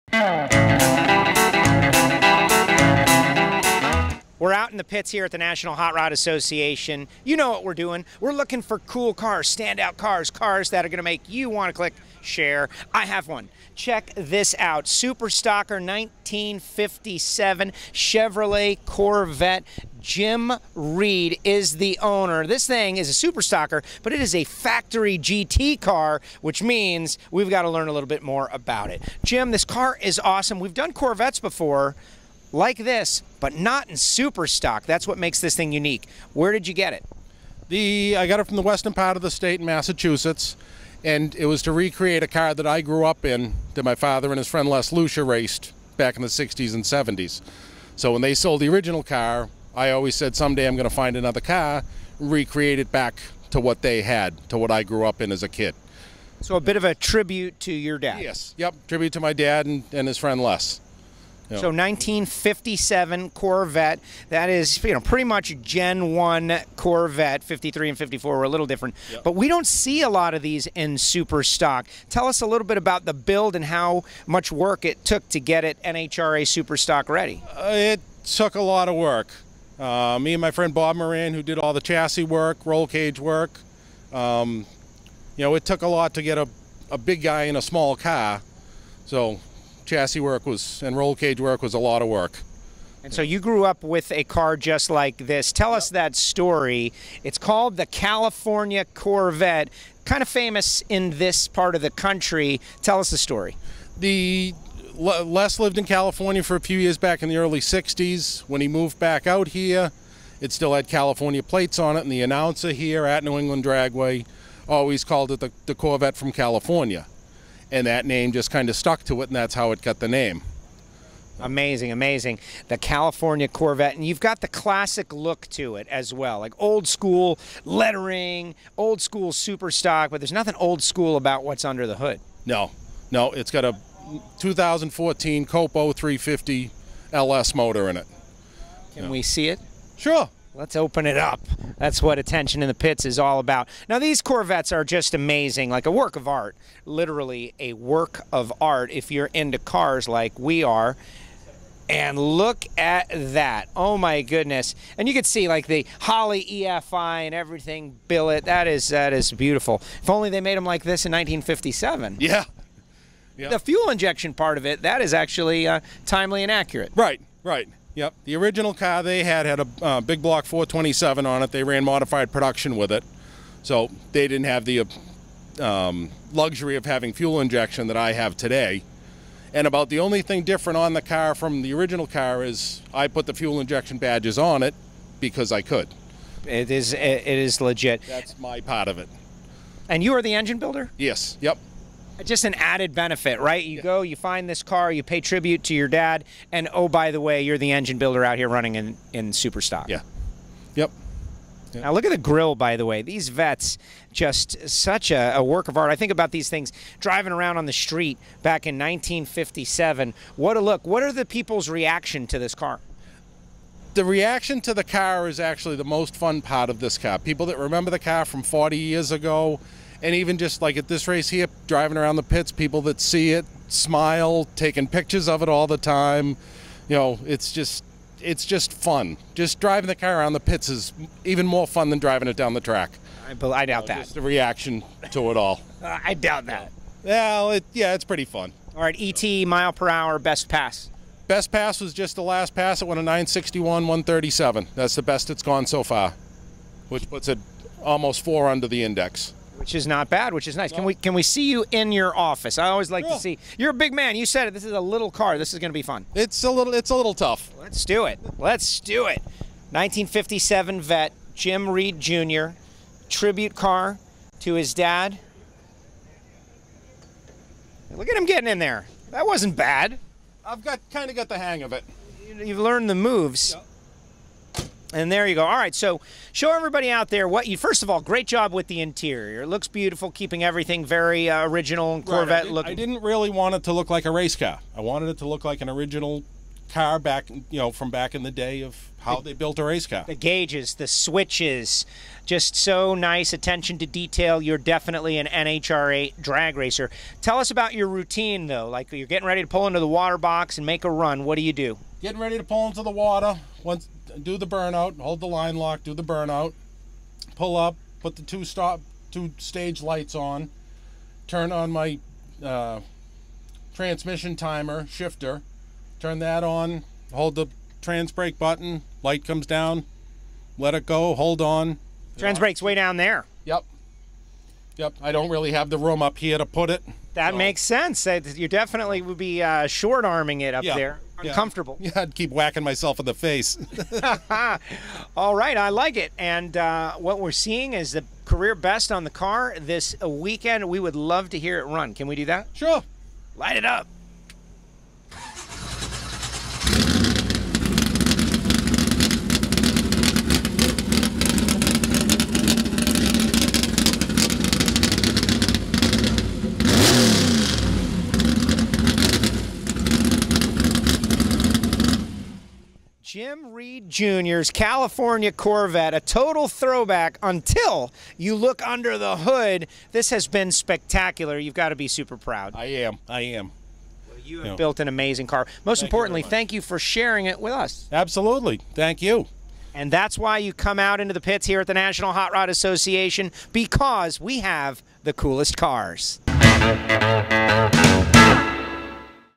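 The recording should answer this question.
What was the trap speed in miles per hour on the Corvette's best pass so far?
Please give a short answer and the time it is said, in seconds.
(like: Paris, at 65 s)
137, at 243 s.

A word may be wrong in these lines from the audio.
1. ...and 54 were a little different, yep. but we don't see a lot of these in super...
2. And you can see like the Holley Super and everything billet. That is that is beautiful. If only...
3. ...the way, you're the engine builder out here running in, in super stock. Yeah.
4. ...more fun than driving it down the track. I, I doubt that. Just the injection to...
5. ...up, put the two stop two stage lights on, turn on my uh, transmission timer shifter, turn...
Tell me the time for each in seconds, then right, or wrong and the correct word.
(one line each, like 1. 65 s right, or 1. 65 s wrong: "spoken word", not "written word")
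1. 67 s right
2. 154 s wrong: "EFI", not "Super"
3. 197 s right
4. 231 s wrong: "reaction", not "injection"
5. 307 s right.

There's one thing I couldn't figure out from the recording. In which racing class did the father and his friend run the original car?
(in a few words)
modified production.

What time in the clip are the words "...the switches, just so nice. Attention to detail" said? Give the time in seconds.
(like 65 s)
290 s.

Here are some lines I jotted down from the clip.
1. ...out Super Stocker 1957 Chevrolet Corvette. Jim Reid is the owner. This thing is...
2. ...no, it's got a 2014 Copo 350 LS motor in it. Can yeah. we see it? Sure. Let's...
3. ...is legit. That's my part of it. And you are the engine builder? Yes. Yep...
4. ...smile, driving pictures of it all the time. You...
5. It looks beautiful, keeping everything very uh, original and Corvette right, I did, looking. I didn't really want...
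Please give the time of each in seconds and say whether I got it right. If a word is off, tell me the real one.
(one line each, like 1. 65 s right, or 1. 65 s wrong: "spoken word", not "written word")
1. 14 s right
2. 133 s right
3. 187 s right
4. 223 s wrong: "taking", not "driving"
5. 279 s right.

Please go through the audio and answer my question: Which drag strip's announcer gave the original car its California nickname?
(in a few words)
New England Dragway.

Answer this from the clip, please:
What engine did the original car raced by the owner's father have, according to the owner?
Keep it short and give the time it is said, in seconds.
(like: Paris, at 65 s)
big block 427, at 170 s.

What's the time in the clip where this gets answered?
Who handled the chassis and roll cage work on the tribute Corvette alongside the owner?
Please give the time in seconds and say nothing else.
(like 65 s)
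80 s.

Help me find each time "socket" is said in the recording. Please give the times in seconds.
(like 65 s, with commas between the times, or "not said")
not said.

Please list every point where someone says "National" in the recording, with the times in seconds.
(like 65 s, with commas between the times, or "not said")
5 s, 381 s.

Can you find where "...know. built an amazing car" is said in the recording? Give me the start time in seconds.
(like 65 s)
374 s.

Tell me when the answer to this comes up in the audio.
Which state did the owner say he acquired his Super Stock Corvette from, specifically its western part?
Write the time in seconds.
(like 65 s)
39 s.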